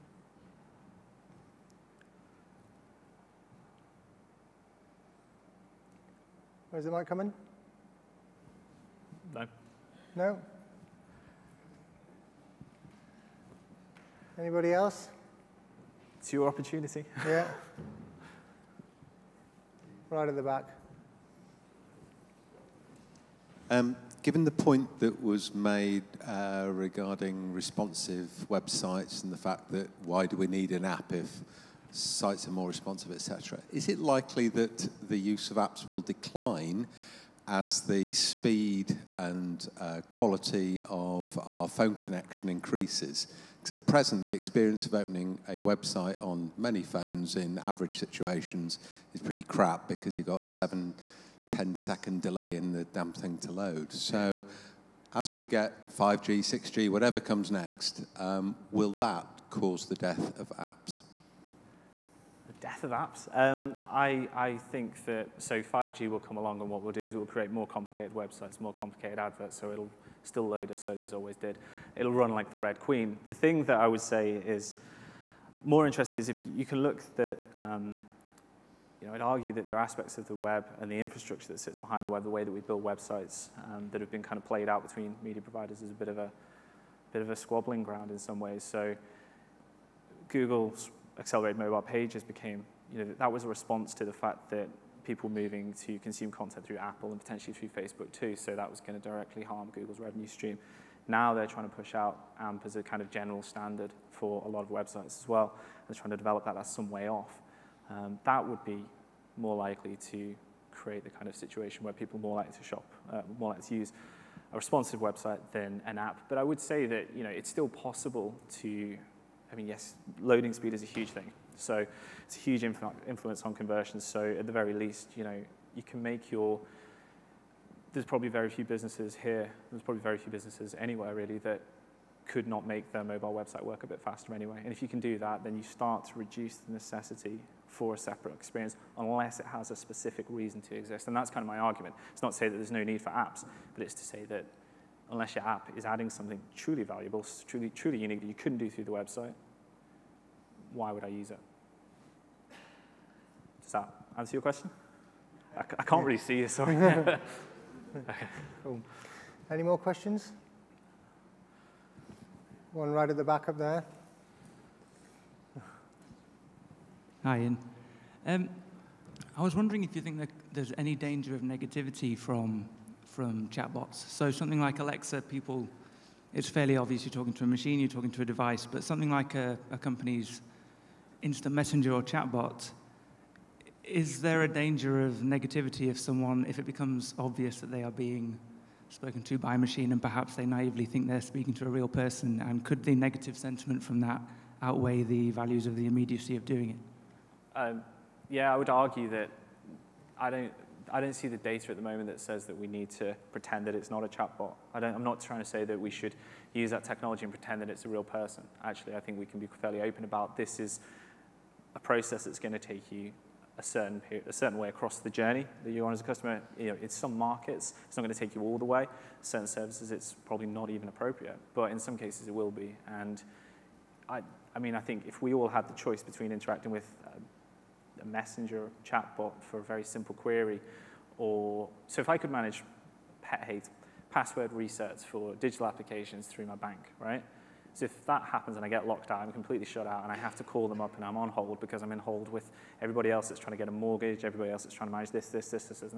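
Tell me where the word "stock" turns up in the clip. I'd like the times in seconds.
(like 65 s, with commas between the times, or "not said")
not said.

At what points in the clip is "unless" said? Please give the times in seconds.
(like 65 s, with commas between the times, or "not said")
138 s, 145 s.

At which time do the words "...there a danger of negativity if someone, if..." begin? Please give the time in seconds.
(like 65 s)
184 s.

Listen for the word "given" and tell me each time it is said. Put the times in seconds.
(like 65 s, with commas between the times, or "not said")
24 s.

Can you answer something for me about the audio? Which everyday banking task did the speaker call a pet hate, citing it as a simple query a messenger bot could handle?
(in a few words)
Password resets.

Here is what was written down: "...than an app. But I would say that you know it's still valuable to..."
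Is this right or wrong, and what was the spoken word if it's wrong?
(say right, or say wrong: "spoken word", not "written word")
wrong: "possible", not "valuable".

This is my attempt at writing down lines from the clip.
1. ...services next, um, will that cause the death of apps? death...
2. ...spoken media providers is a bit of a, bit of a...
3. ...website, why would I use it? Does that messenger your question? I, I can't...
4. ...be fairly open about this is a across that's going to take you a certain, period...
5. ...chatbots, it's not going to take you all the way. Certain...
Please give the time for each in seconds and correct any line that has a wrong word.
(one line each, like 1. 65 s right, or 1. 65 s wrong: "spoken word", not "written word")
1. 57 s wrong: "comes", not "services"
2. 84 s wrong: "between", not "spoken"
3. 148 s wrong: "answer", not "messenger"
4. 209 s wrong: "process", not "across"
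5. 217 s wrong: "markets", not "chatbots".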